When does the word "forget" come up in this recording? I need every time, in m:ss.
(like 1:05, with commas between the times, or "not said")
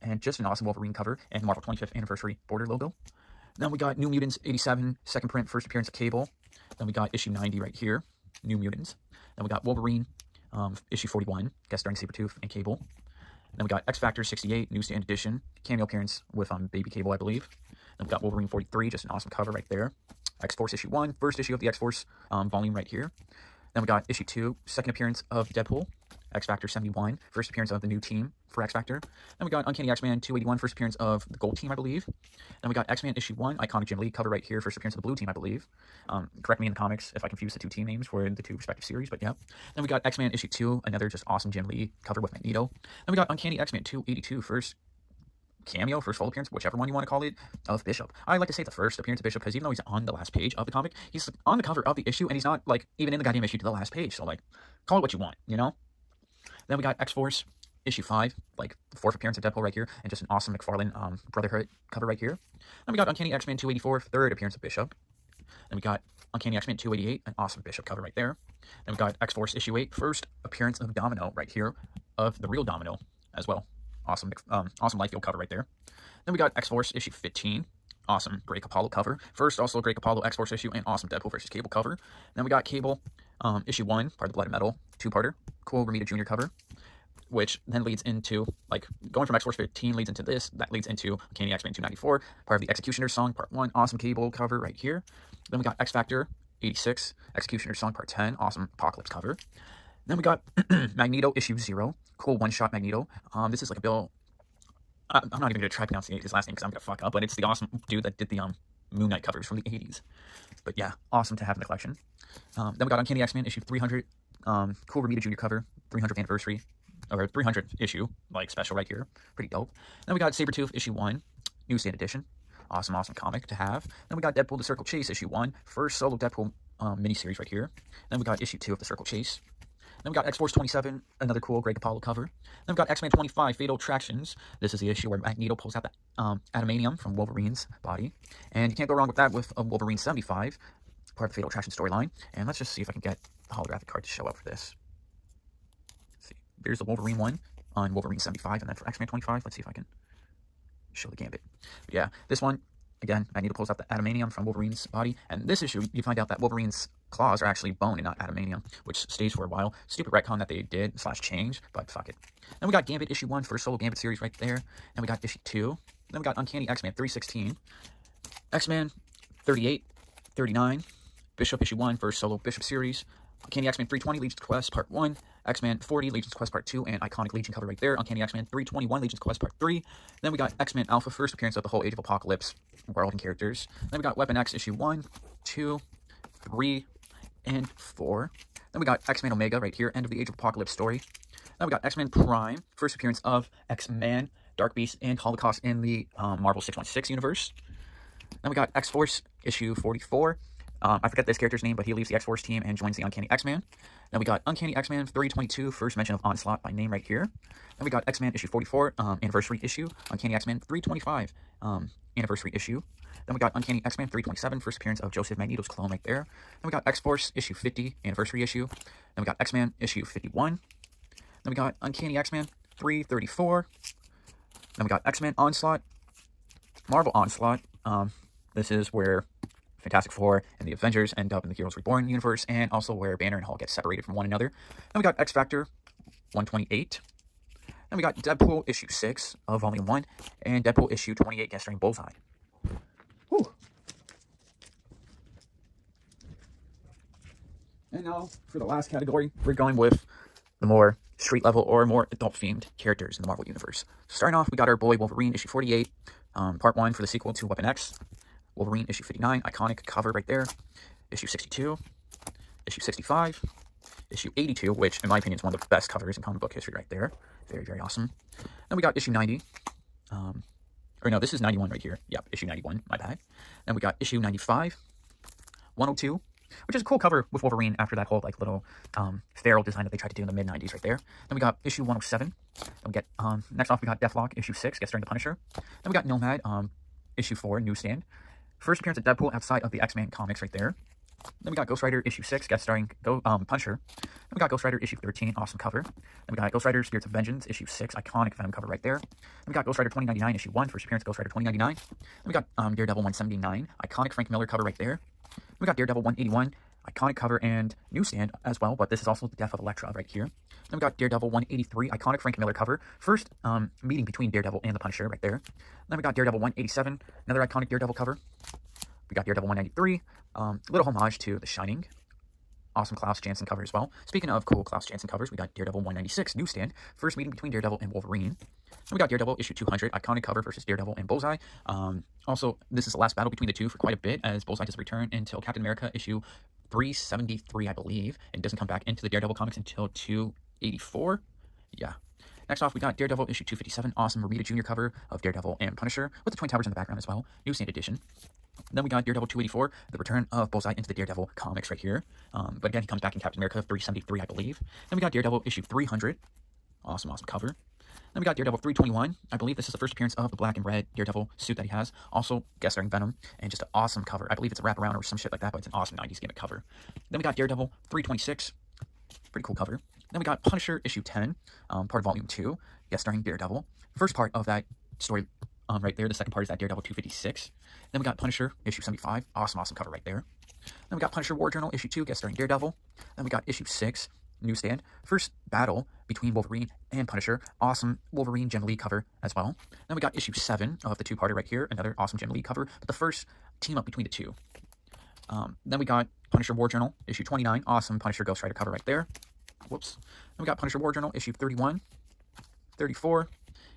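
3:21.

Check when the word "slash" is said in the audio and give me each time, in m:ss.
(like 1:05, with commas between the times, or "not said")
2:40.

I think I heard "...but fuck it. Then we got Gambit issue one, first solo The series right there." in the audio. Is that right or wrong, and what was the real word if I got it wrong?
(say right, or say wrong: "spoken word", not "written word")
wrong: "Gambit", not "The".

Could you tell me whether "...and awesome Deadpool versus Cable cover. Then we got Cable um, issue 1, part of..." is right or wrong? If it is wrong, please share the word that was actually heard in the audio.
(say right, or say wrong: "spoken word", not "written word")
right.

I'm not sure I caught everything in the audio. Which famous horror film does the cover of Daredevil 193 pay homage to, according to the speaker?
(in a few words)
The Shining.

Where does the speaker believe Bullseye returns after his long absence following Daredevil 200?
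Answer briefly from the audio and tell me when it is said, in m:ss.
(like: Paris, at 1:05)
Captain America 373, at 5:35.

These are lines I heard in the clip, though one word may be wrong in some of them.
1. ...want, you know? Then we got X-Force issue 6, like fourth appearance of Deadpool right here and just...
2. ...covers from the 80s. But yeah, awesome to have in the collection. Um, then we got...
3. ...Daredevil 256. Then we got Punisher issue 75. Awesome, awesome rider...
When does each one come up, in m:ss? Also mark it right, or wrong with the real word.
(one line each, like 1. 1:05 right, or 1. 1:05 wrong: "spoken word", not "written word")
1. 0:55 wrong: "5", not "6"
2. 1:49 right
3. 6:16 wrong: "cover", not "rider".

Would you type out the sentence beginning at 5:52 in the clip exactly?
Um, but again, he comes back in Captain America 373, I believe.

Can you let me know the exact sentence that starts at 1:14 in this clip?
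Awesome, um, awesome Liefeld cover right there.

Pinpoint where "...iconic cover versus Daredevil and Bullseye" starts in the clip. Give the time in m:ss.
5:29.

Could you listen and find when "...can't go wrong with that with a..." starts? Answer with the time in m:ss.
2:18.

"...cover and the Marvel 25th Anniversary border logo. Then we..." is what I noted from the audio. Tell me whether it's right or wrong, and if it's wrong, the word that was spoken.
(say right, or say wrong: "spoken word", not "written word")
right.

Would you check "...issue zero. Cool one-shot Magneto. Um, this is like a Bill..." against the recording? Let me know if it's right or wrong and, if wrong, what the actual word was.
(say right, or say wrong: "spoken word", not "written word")
right.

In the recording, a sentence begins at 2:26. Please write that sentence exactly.
see, there's the Wolverine one on Wolverine 75.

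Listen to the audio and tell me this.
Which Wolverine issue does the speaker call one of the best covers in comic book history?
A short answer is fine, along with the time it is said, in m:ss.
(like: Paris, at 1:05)
82, at 4:24.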